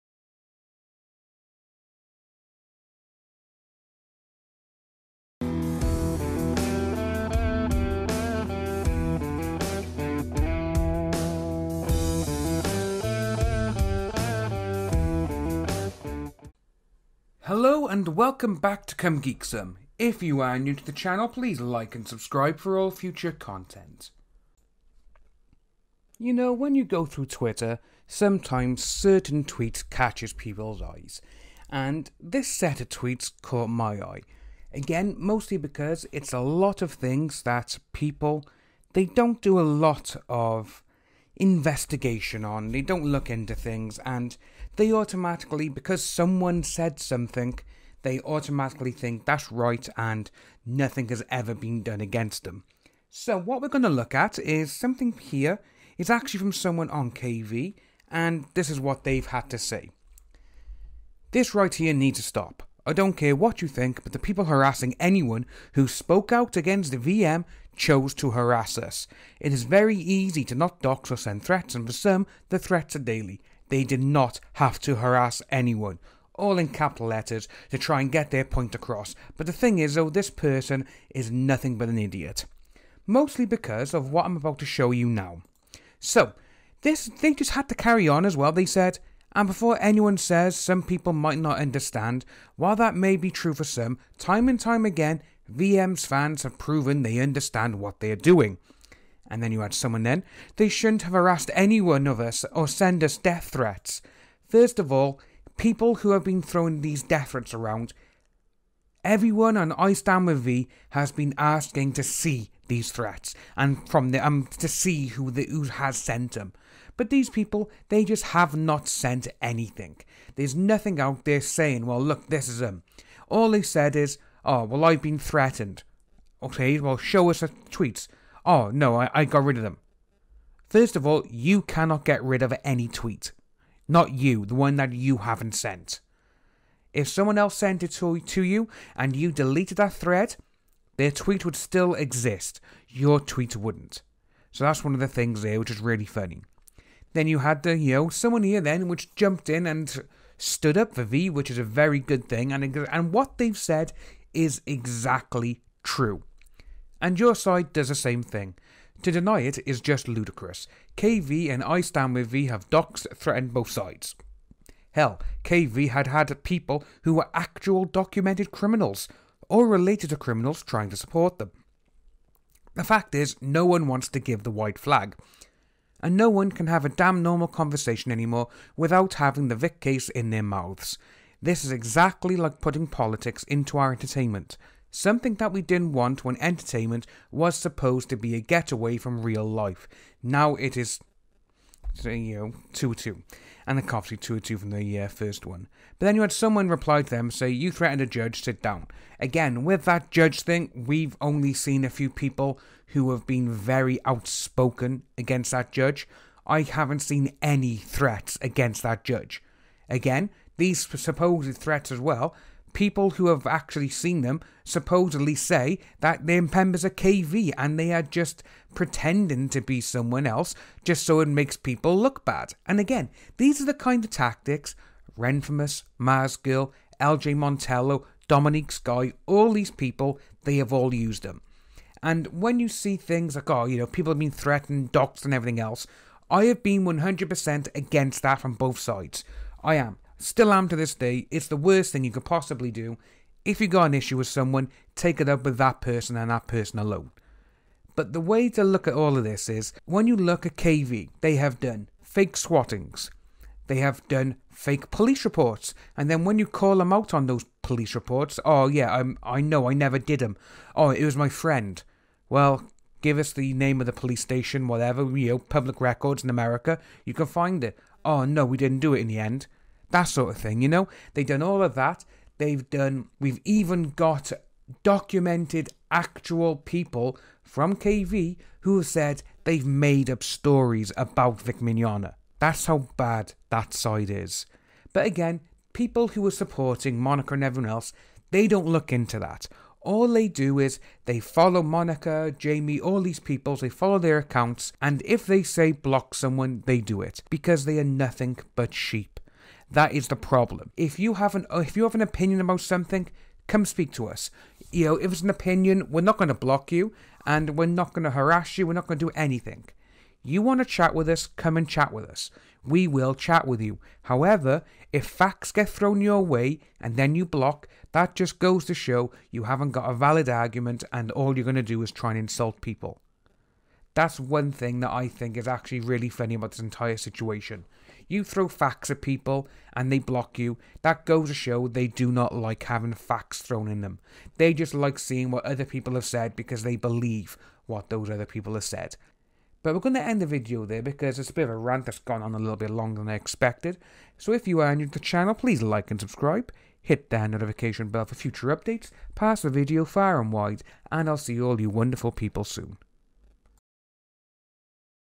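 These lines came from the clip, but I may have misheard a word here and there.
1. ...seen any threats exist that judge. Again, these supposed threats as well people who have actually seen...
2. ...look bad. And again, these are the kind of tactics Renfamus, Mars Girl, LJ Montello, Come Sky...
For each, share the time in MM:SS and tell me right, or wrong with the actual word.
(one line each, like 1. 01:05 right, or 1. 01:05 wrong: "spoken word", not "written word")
1. 03:26 wrong: "against", not "exist"
2. 03:41 wrong: "Dominique", not "Come".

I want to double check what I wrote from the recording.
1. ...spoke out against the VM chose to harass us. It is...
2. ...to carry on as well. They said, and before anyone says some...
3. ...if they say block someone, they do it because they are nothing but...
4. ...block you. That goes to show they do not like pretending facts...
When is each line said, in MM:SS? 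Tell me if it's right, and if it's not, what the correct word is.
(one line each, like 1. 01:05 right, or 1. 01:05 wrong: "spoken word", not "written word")
1. 01:05 right
2. 01:27 right
3. 04:55 right
4. 05:29 wrong: "having", not "pretending".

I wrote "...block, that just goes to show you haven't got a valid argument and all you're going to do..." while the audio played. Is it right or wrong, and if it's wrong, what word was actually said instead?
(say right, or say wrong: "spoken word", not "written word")
right.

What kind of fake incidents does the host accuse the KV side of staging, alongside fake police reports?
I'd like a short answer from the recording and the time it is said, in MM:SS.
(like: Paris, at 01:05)
Fake swattings, at 04:12.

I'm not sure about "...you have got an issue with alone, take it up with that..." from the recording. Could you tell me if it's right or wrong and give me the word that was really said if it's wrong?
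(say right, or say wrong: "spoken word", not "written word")
wrong: "someone", not "alone".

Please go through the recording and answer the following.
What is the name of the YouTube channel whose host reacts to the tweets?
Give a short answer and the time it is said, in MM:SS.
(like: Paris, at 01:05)
Come Geek Some, at 00:18.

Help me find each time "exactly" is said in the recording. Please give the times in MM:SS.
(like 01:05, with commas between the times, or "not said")
02:34, 03:01.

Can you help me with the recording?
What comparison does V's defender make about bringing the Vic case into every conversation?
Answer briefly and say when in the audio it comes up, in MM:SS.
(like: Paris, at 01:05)
Putting politics into our entertainment, at 03:02.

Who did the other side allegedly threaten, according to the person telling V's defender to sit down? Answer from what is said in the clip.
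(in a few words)
A judge.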